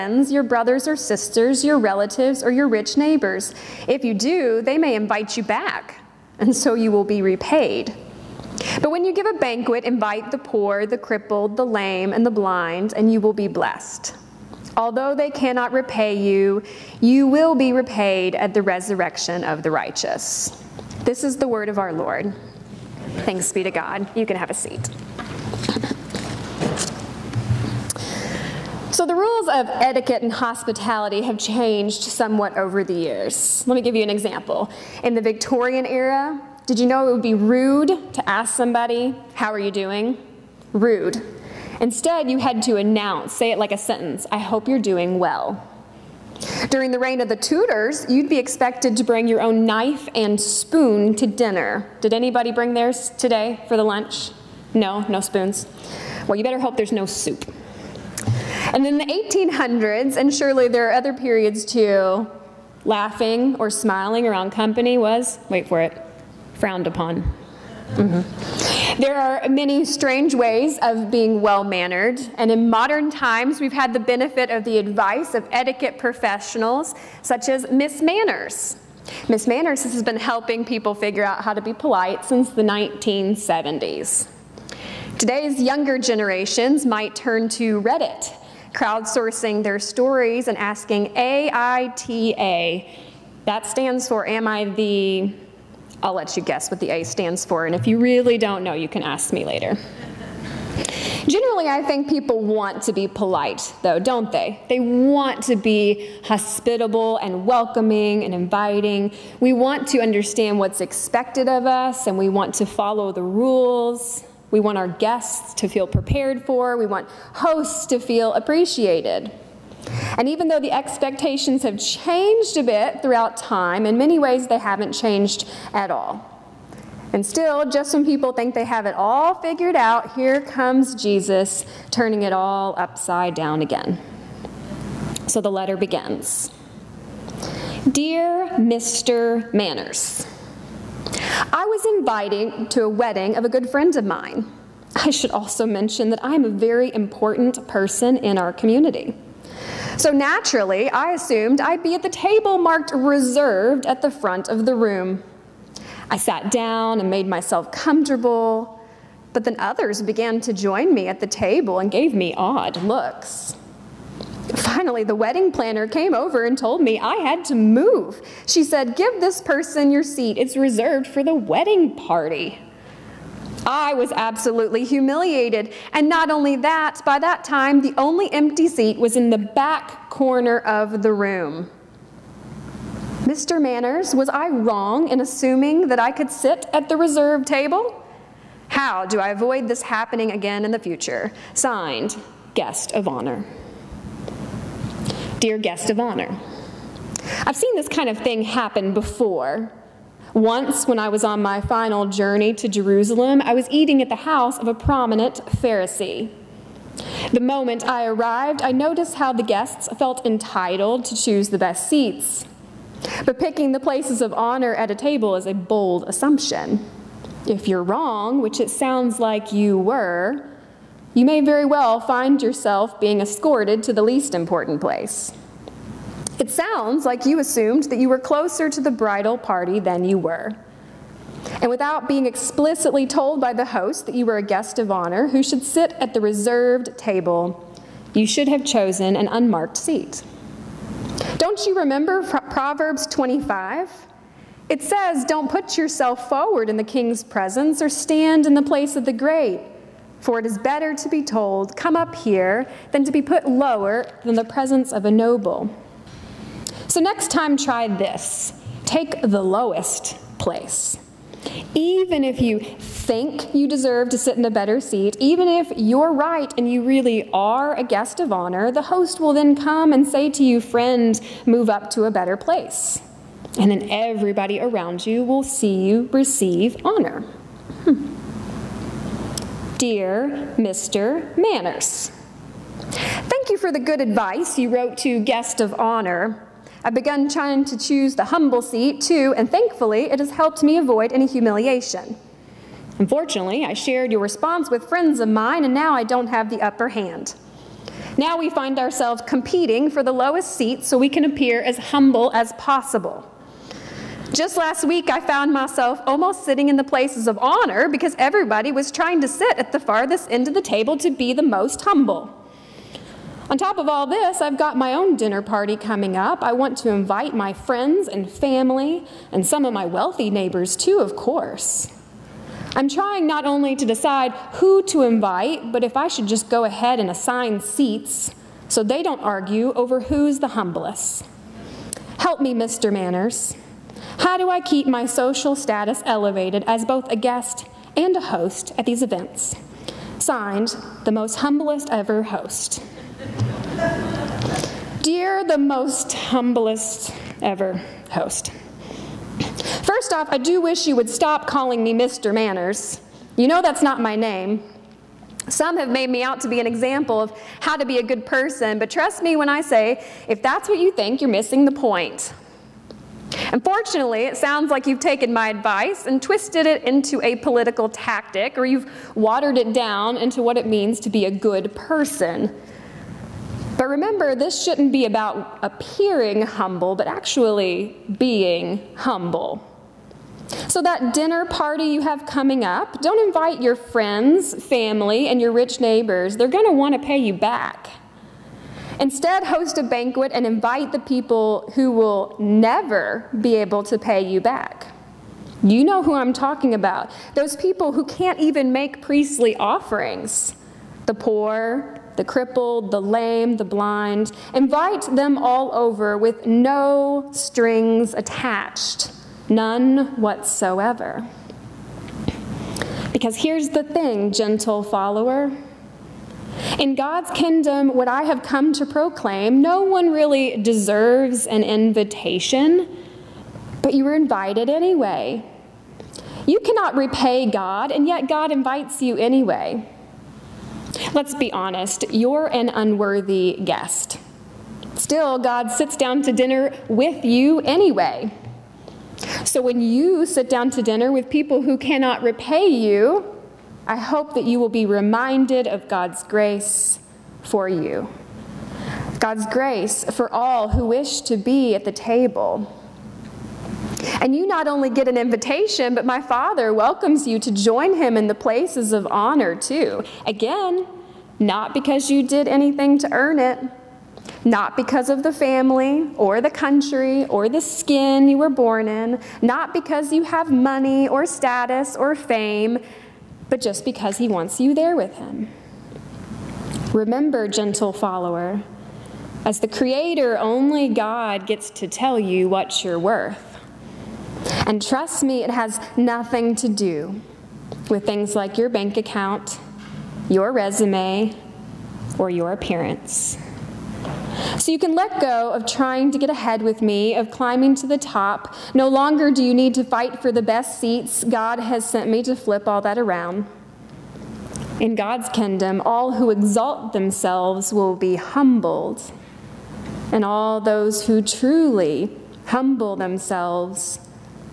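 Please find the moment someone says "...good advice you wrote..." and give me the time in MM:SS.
04:43.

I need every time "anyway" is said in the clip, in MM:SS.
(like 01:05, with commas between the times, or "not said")
07:04, 07:09, 07:17.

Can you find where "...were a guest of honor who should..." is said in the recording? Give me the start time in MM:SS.
03:54.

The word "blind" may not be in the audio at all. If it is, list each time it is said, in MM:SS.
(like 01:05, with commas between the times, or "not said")
00:12, 06:43.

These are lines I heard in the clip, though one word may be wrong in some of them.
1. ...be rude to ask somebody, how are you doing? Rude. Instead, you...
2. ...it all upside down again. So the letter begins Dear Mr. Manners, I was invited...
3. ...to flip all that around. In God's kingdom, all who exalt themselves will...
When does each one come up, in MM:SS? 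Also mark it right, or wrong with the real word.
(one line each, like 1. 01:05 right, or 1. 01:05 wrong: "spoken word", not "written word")
1. 00:37 right
2. 02:12 right
3. 08:22 right.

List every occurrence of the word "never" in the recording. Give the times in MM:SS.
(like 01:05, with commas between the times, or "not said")
06:32.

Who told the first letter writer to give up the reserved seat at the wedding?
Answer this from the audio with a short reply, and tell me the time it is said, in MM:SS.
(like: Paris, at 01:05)
The wedding planner, at 02:45.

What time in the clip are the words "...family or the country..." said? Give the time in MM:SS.
07:45.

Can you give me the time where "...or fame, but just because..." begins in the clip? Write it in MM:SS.
07:51.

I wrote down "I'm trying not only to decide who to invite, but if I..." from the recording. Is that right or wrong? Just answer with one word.
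right.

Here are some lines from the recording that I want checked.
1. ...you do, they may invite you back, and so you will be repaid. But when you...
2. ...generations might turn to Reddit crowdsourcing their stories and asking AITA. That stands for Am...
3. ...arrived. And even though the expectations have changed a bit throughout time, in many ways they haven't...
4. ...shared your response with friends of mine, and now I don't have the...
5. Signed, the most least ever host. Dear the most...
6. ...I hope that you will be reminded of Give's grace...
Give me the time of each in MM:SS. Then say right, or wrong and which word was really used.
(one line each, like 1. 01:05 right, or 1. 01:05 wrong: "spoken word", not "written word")
1. 00:04 right
2. 01:25 right
3. 01:58 wrong: "appreciated", not "arrived"
4. 04:53 right
5. 05:40 wrong: "humblest", not "least"
6. 07:23 wrong: "God", not "Give".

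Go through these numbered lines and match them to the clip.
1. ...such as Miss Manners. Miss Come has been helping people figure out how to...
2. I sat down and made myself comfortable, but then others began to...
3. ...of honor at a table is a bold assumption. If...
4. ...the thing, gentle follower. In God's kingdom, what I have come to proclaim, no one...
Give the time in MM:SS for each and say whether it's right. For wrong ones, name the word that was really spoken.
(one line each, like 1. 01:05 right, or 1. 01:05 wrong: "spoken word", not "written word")
1. 01:17 wrong: "Manners", not "Come"
2. 02:36 right
3. 03:34 right
4. 06:53 right.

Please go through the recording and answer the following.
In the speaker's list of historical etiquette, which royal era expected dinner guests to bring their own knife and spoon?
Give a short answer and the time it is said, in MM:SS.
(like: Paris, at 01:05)
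The Tudors, at 00:47.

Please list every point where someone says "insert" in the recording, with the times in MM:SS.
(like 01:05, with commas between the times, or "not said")
not said.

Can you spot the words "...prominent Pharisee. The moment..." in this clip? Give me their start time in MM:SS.
03:24.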